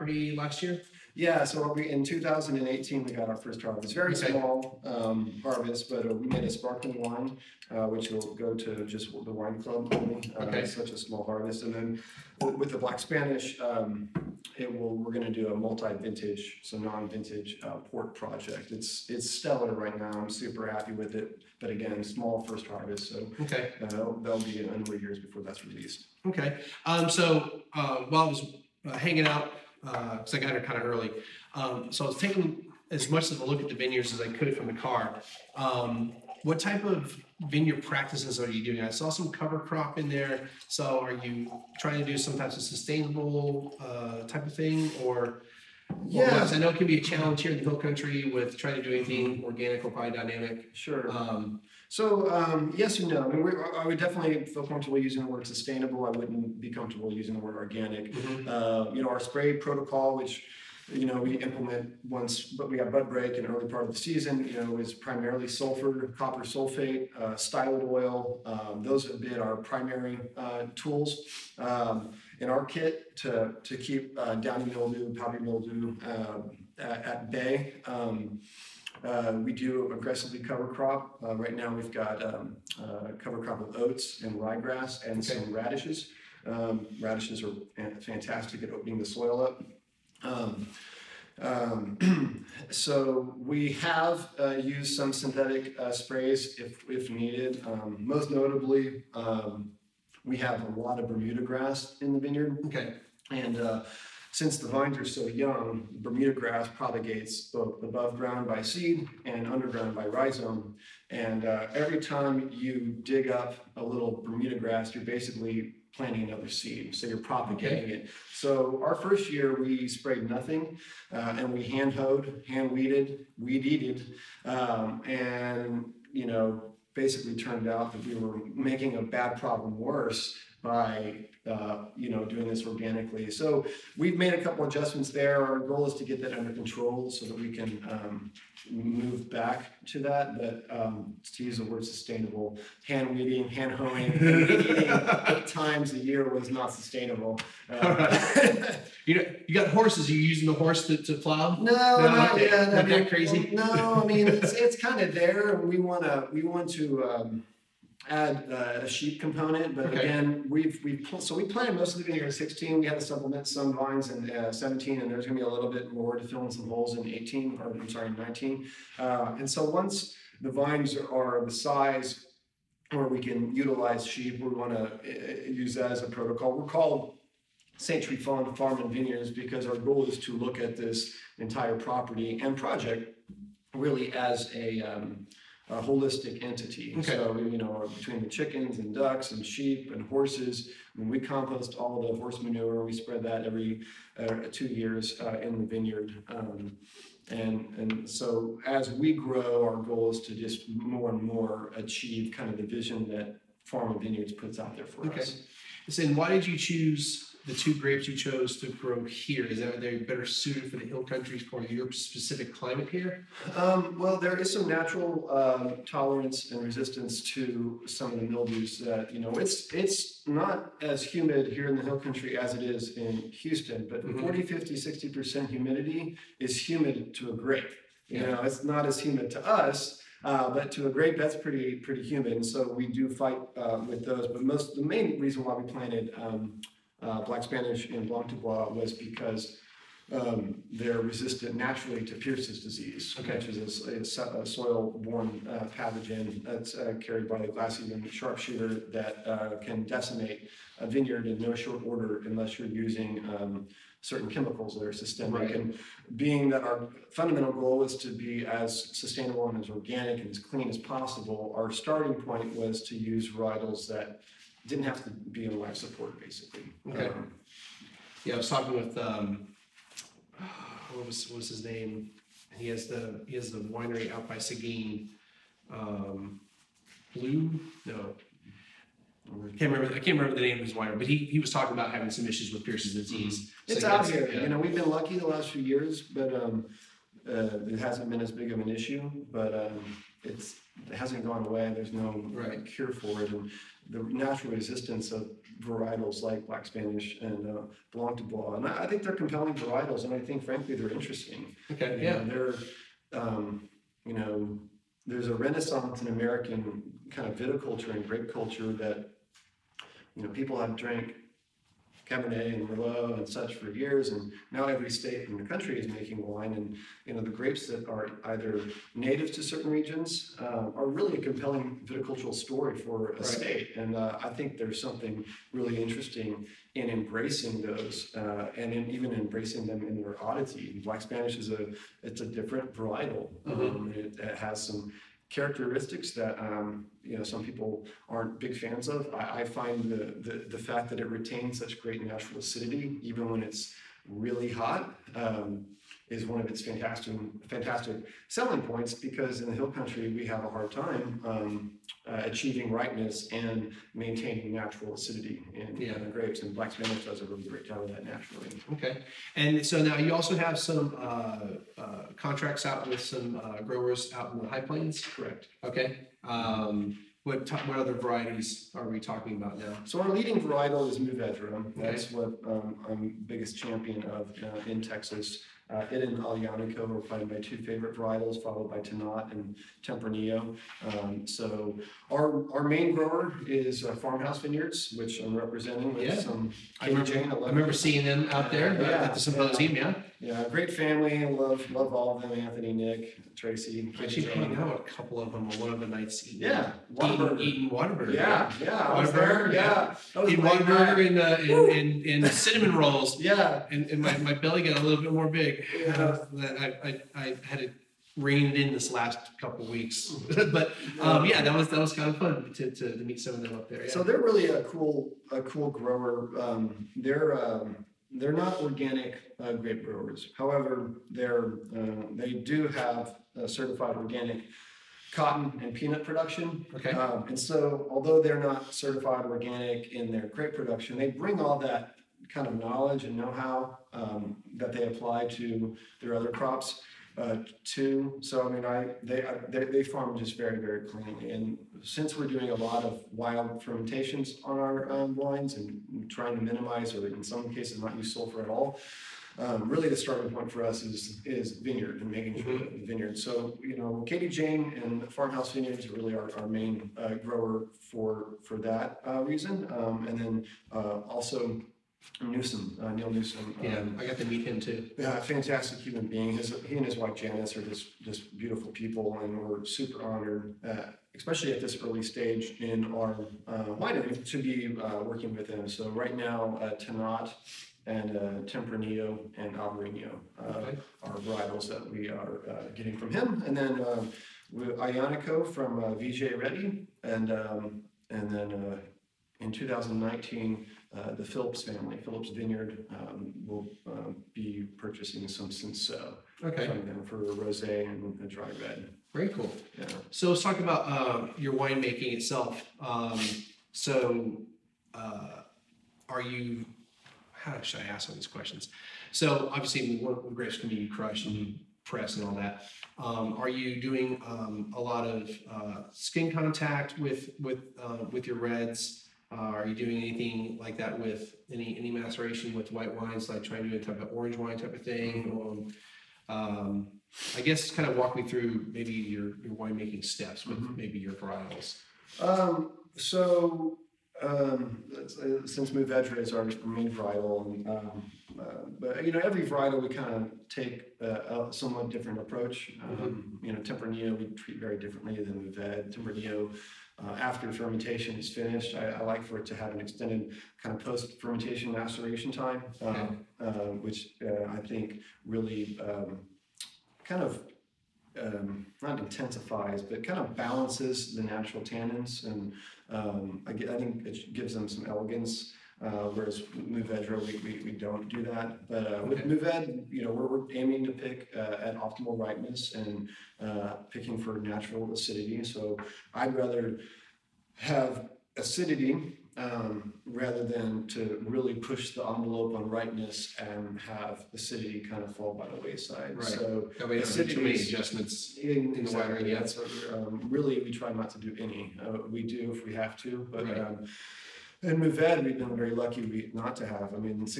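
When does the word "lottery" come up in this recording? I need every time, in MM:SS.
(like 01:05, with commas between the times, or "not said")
not said.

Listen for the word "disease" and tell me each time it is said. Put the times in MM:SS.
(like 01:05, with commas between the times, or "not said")
04:02, 04:42.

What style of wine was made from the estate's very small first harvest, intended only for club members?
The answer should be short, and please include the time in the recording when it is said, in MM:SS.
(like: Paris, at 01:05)
Sparkling wine, at 00:06.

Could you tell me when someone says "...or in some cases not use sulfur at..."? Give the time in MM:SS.
07:26.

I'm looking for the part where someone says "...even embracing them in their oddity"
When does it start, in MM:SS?
05:28.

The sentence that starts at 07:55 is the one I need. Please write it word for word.
So right now, uh, Tannat and uh, Tempranillo and Alvarino uh, Okay.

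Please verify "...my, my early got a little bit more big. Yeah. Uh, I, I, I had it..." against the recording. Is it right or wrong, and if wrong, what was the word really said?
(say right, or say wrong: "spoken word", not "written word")
wrong: "belly", not "early".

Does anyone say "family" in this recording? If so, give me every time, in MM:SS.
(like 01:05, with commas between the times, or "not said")
06:30, 08:11.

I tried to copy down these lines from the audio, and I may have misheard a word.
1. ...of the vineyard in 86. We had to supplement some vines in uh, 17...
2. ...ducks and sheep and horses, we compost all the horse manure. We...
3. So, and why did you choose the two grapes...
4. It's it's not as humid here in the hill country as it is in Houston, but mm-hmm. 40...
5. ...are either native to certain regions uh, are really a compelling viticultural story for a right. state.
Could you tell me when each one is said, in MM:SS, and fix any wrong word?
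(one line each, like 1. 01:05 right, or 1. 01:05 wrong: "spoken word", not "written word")
1. 02:41 wrong: "16", not "86"
2. 03:08 right
3. 03:25 right
4. 03:39 right
5. 05:17 right.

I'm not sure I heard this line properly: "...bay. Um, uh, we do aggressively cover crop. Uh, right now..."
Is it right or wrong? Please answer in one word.
right.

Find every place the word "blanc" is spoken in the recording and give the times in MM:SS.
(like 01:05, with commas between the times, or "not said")
03:58, 04:57.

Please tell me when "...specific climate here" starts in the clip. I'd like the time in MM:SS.
03:31.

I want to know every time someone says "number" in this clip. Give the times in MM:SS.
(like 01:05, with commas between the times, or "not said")
00:24.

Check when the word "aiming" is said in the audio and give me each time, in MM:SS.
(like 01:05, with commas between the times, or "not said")
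09:30.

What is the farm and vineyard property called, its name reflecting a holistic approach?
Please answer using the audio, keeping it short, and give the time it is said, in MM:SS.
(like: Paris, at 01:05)
St. Tryphon, at 02:57.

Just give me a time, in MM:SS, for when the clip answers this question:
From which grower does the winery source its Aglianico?
08:05.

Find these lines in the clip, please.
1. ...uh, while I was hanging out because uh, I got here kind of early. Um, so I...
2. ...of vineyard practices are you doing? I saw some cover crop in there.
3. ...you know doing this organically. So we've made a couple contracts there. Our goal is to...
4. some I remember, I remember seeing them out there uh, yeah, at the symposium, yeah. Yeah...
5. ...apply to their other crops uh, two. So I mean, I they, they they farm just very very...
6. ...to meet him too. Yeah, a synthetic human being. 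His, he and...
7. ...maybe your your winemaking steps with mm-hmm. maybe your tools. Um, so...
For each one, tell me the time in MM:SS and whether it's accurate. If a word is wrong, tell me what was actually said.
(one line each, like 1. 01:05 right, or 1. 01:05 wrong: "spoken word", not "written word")
1. 00:27 right
2. 00:36 right
3. 02:11 wrong: "adjustments", not "contracts"
4. 06:26 right
5. 07:14 right
6. 07:44 wrong: "fantastic", not "synthetic"
7. 08:48 wrong: "varietals", not "tools".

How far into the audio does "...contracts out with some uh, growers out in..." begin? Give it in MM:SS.
06:02.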